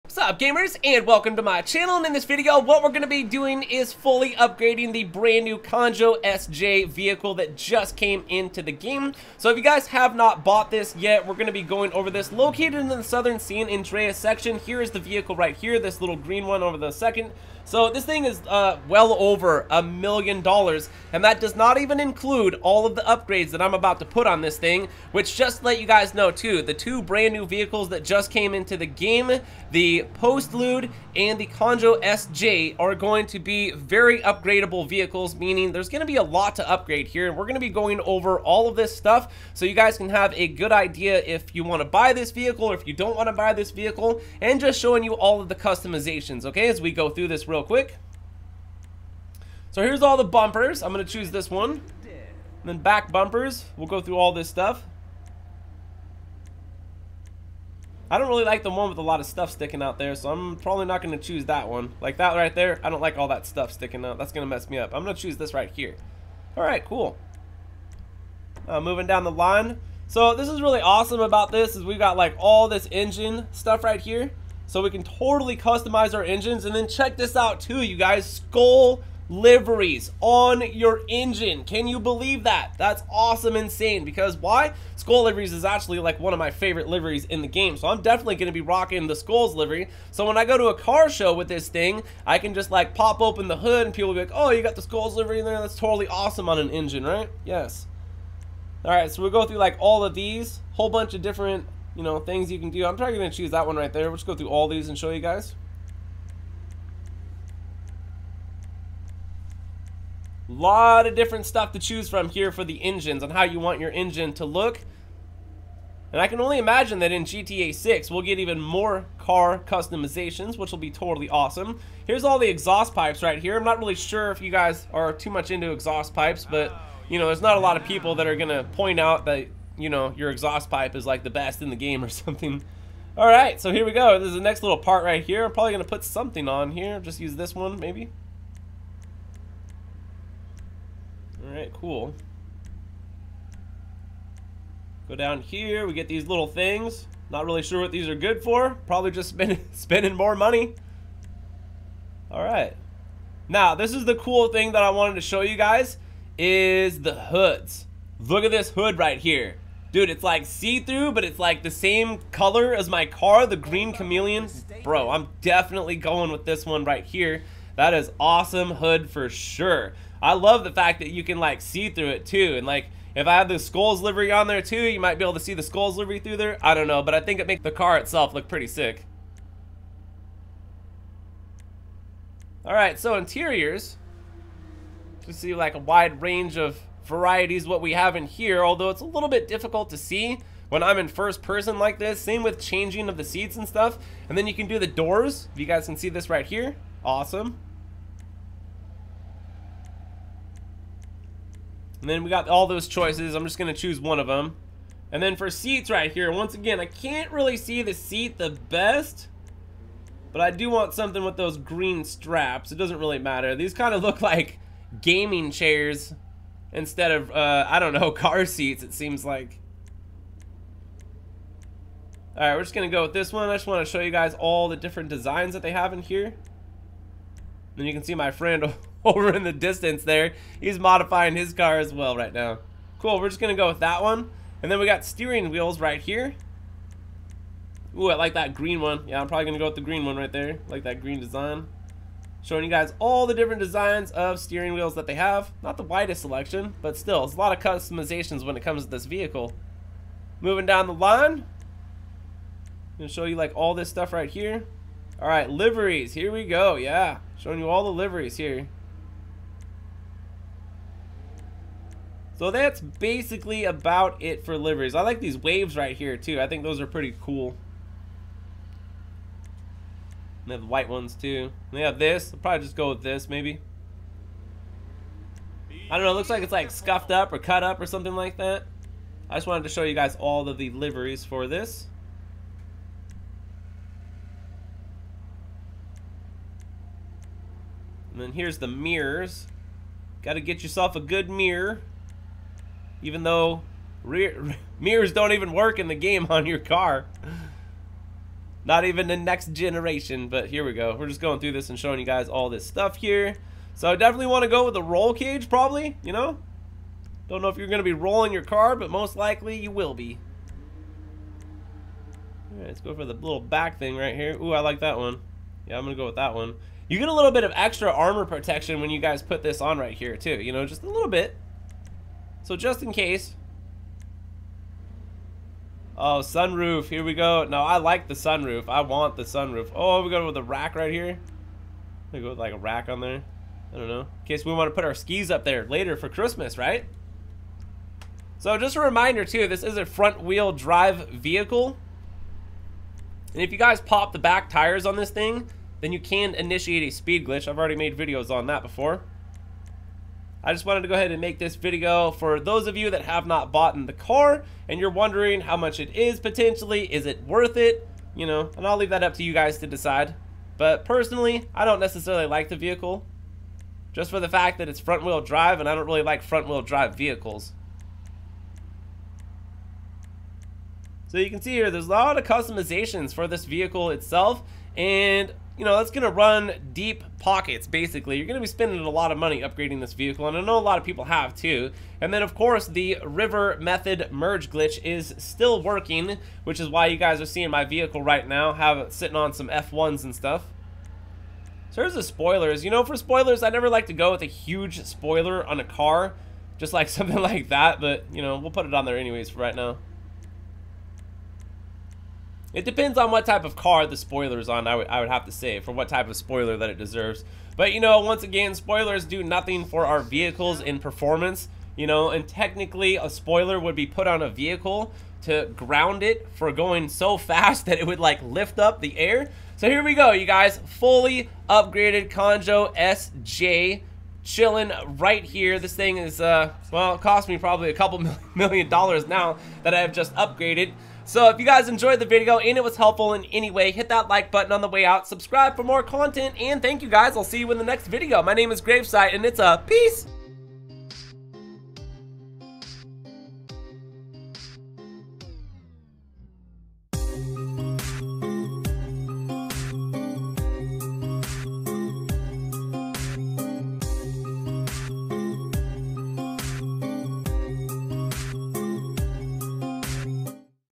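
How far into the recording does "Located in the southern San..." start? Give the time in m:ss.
0:12.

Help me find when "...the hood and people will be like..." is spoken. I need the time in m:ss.
1:33.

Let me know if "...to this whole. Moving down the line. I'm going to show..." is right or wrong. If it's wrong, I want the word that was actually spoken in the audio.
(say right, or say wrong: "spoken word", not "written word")
wrong: "vehicle", not "whole".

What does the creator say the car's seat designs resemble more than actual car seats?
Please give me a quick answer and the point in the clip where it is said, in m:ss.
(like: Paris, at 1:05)
gaming chairs, at 3:35.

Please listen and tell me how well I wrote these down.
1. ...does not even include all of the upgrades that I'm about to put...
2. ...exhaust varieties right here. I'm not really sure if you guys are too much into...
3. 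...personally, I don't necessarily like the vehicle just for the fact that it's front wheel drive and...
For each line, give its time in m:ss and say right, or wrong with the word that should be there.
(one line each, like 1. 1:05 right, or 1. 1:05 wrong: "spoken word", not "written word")
1. 0:21 right
2. 2:02 wrong: "pipes", not "varieties"
3. 6:00 right.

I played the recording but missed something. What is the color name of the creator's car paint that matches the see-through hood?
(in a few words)
green chameleon.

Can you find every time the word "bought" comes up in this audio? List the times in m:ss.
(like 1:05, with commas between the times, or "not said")
0:10, 5:53.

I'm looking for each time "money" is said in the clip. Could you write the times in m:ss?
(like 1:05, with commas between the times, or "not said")
2:30, 6:19.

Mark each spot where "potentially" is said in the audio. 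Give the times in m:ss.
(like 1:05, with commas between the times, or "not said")
5:56.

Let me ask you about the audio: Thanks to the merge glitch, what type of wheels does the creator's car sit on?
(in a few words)
F1s.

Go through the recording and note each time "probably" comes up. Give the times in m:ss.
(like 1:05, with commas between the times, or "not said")
1:00, 1:42, 2:15, 2:28, 3:59, 4:32, 5:05, 7:07.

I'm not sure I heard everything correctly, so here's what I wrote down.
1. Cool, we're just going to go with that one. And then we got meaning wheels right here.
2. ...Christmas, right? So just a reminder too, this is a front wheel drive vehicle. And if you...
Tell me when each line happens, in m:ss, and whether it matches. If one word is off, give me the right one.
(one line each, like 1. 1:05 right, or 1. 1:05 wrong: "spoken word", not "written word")
1. 3:52 wrong: "steering", not "meaning"
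2. 5:36 right.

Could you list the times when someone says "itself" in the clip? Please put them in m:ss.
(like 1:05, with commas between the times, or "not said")
2:57, 6:13.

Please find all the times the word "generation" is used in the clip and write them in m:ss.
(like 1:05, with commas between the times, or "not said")
4:59.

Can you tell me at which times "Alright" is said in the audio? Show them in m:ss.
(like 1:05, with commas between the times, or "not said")
2:21, 2:32, 3:42.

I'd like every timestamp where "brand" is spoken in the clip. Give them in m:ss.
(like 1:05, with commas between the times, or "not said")
0:05, 0:27.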